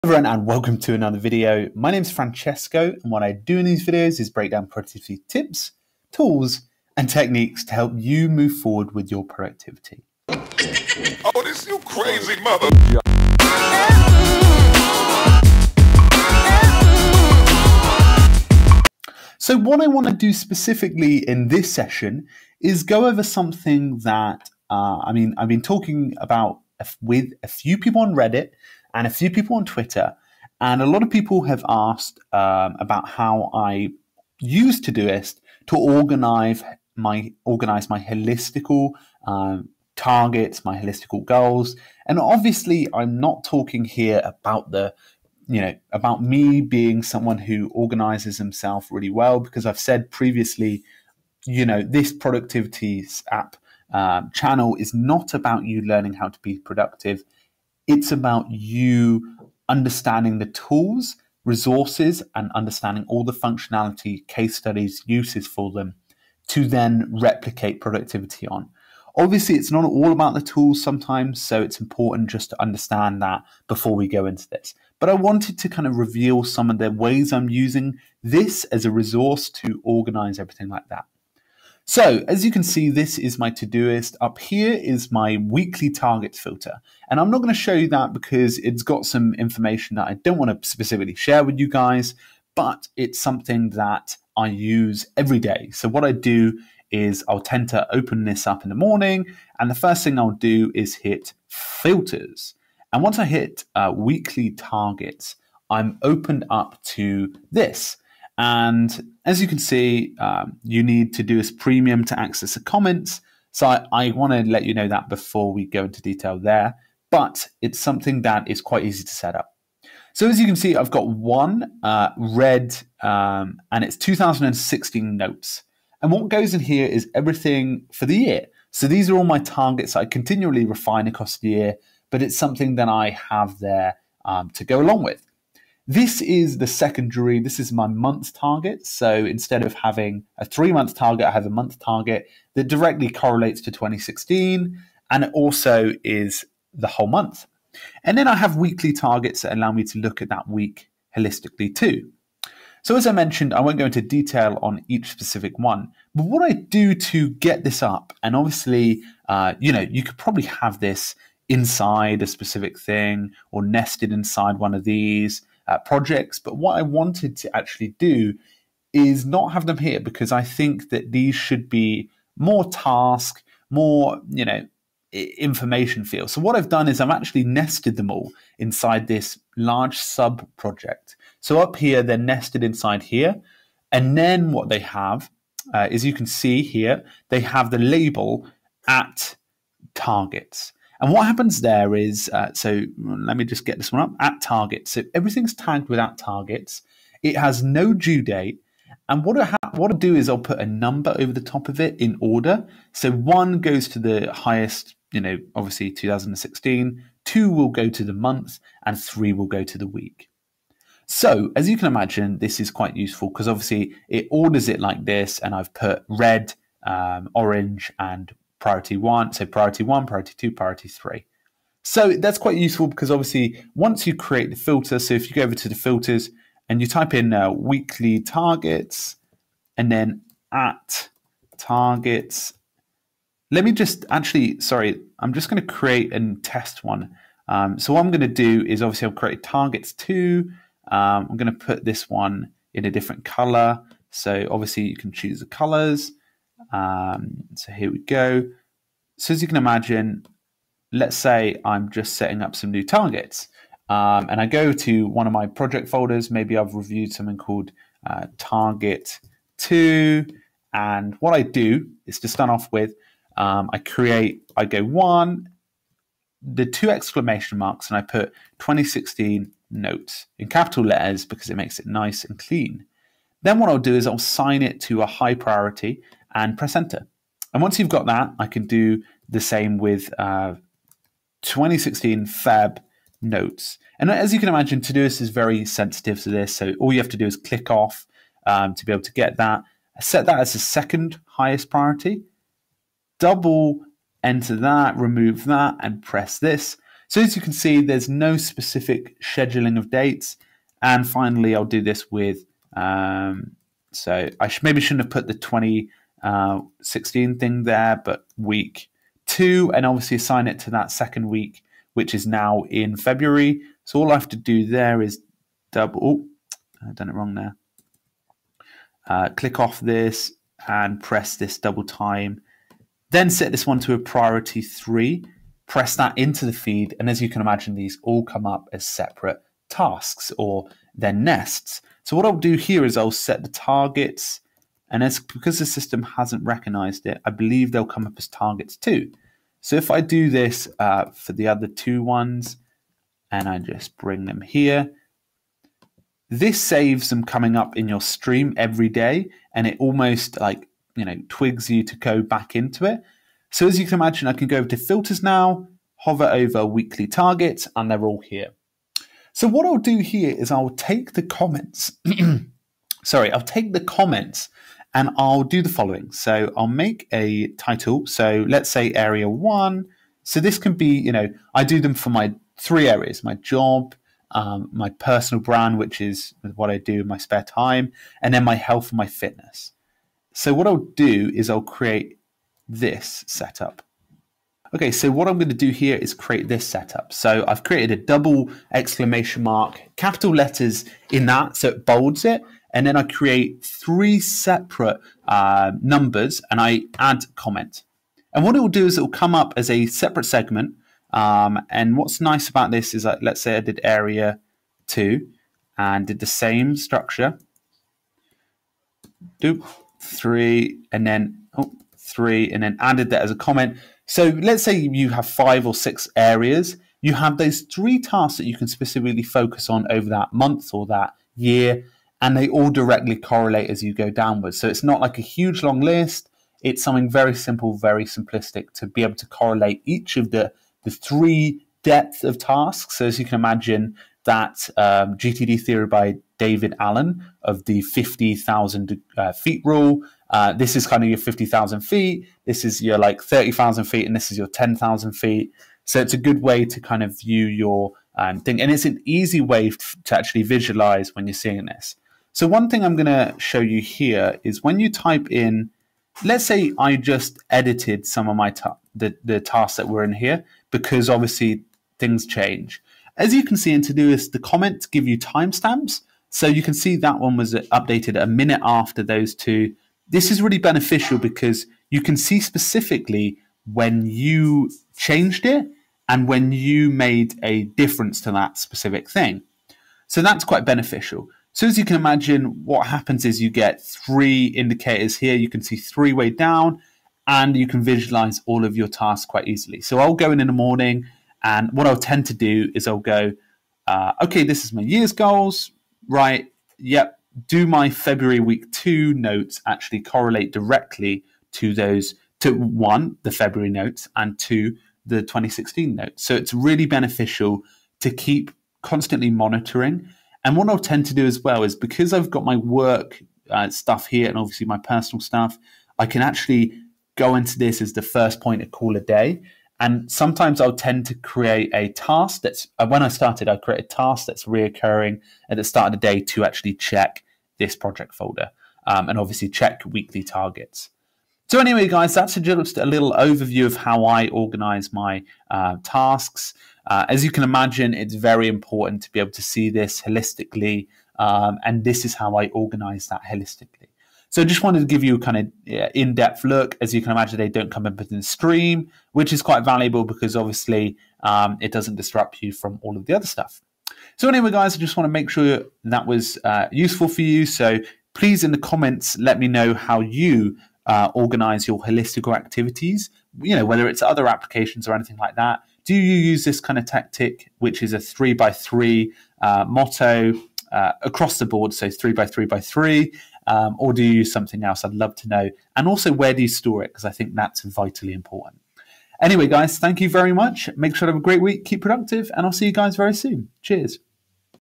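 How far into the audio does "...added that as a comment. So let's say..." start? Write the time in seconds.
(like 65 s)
412 s.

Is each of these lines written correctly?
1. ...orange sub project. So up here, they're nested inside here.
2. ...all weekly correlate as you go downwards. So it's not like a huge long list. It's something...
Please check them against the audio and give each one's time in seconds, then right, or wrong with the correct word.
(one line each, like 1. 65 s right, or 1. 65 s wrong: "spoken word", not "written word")
1. 179 s wrong: "large", not "orange"
2. 422 s wrong: "directly", not "weekly".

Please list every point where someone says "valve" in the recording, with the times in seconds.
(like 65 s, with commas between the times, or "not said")
not said.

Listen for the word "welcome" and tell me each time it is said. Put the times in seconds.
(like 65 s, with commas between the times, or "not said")
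0 s.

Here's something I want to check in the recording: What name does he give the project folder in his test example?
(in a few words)
Target 2.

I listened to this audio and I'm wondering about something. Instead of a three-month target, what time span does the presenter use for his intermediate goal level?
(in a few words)
a month.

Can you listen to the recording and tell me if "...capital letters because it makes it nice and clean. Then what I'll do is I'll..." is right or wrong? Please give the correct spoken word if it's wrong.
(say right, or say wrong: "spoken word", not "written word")
right.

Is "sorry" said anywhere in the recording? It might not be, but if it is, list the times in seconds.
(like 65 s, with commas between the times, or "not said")
234 s, 363 s.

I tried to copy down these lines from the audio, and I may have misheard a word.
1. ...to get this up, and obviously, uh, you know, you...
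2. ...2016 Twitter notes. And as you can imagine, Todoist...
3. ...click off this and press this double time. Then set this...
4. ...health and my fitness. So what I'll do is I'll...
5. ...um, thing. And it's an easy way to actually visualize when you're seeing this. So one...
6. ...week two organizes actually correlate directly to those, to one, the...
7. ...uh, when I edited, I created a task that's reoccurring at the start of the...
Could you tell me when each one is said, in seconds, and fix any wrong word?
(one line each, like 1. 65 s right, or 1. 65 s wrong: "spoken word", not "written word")
1. 156 s right
2. 281 s wrong: "Feb", not "Twitter"
3. 319 s right
4. 378 s right
5. 448 s right
6. 498 s wrong: "notes", not "organizes"
7. 522 s wrong: "started", not "edited".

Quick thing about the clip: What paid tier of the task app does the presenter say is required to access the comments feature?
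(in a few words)
Todoist premium.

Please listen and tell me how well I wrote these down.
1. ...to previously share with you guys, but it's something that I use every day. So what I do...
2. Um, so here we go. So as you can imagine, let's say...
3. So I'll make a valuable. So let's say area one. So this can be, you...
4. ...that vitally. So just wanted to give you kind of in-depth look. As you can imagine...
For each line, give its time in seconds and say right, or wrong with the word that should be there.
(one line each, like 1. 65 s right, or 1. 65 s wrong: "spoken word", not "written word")
1. 90 s wrong: "specifically", not "previously"
2. 246 s right
3. 366 s wrong: "title", not "valuable"
4. 543 s wrong: "holistically", not "vitally".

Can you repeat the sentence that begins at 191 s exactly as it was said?
And what happens there is, uh, so mm, let me just get this one up at targets.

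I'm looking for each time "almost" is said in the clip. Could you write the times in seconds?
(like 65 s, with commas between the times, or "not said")
349 s.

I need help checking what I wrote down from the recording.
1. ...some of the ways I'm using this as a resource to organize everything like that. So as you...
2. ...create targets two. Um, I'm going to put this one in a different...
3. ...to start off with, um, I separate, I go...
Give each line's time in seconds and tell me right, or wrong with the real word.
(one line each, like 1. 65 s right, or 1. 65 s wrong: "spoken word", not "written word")
1. 76 s right
2. 239 s right
3. 262 s wrong: "create", not "separate".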